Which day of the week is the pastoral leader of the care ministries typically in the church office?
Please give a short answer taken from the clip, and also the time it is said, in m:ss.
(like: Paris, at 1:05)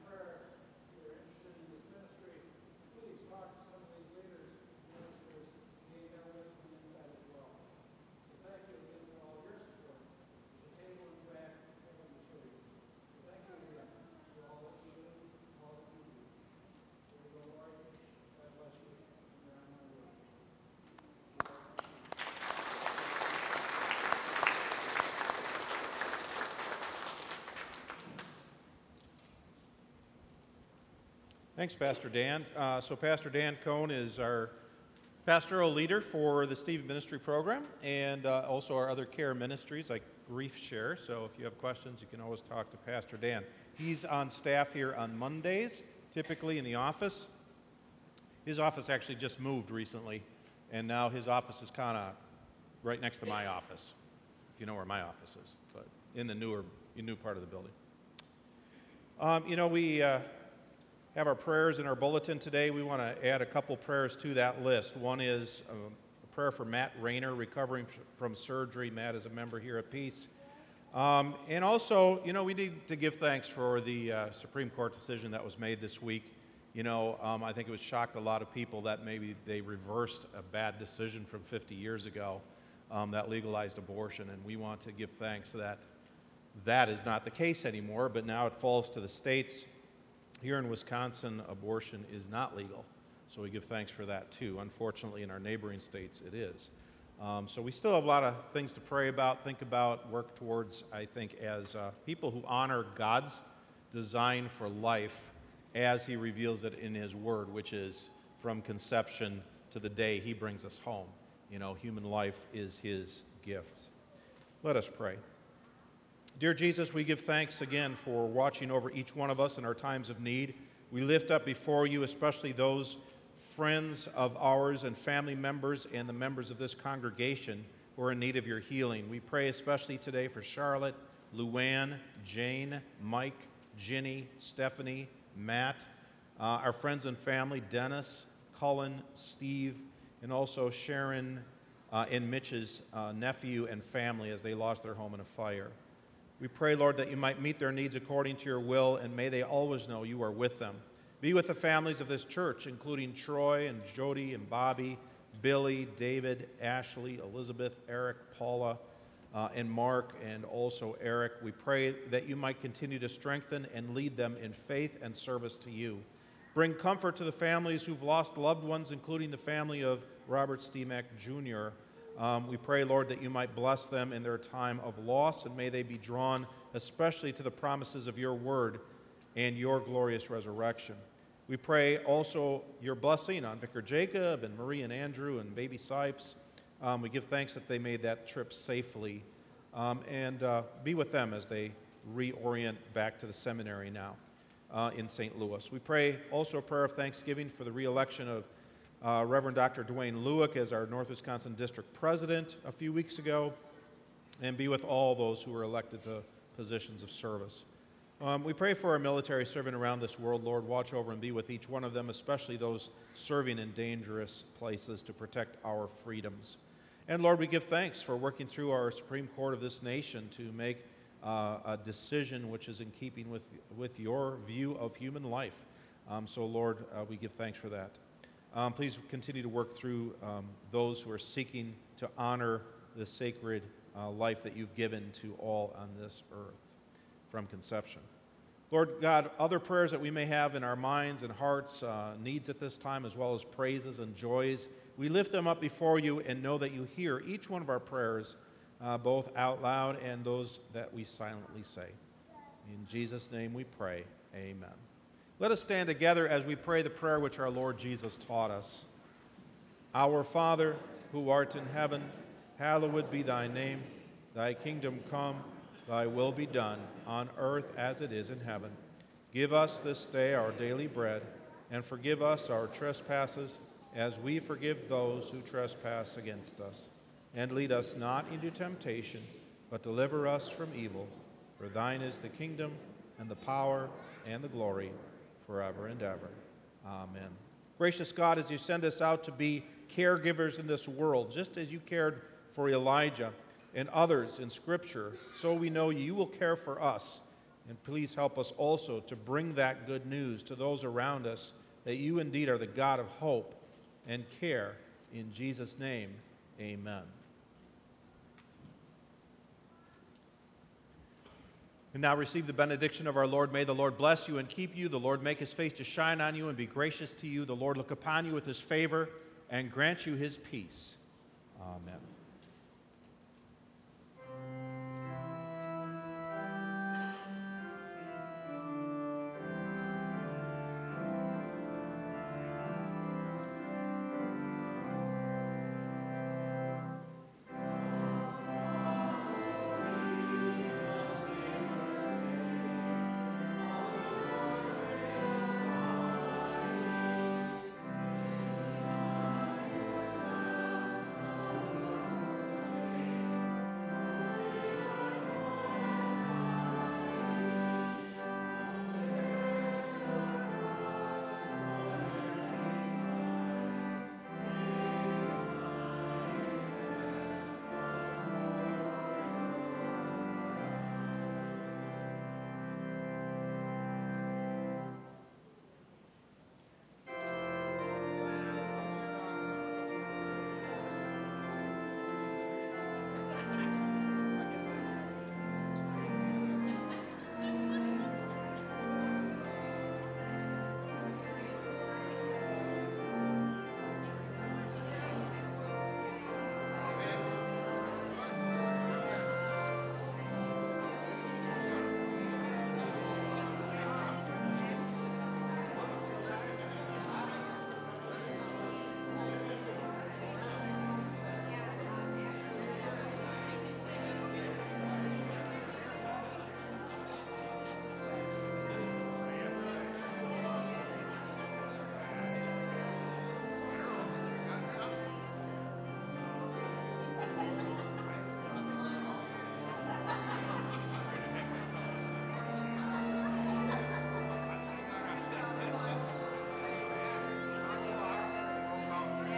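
Mondays, at 0:45.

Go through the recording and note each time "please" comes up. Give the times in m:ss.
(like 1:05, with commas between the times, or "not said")
3:48, 4:57.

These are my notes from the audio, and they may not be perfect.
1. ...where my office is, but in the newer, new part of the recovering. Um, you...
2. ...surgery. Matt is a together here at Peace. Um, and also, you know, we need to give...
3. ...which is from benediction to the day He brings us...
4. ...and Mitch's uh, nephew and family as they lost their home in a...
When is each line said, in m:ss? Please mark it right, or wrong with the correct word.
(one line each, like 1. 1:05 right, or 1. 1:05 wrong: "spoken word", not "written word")
1. 0:54 wrong: "building", not "recovering"
2. 1:08 wrong: "member", not "together"
3. 1:47 wrong: "conception", not "benediction"
4. 2:22 right.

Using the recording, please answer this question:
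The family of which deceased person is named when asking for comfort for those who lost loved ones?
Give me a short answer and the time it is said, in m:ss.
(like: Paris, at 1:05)
Robert Steemack Jr., at 2:50.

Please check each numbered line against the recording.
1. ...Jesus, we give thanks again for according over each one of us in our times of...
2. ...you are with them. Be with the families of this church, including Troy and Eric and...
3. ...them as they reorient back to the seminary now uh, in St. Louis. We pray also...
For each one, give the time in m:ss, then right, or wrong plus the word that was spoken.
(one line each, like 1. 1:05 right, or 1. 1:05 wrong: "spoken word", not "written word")
1. 1:56 wrong: "watching", not "according"
2. 2:30 wrong: "Jody", not "Eric"
3. 3:11 right.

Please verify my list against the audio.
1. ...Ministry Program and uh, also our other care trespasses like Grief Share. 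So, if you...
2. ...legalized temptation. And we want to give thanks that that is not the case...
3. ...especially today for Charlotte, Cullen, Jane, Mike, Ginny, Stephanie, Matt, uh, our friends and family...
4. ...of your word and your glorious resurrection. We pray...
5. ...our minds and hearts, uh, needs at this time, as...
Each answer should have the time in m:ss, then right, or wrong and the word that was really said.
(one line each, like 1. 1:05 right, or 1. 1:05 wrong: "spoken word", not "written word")
1. 0:36 wrong: "ministries", not "trespasses"
2. 1:23 wrong: "abortion", not "temptation"
3. 2:09 wrong: "Luann", not "Cullen"
4. 2:58 right
5. 4:00 right.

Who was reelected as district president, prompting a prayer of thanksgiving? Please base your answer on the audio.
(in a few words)
Dwayne Lueck.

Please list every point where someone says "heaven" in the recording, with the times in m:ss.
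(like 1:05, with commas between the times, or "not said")
4:21, 4:28.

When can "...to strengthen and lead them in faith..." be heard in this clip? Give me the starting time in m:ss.
2:42.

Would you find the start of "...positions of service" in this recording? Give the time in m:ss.
3:26.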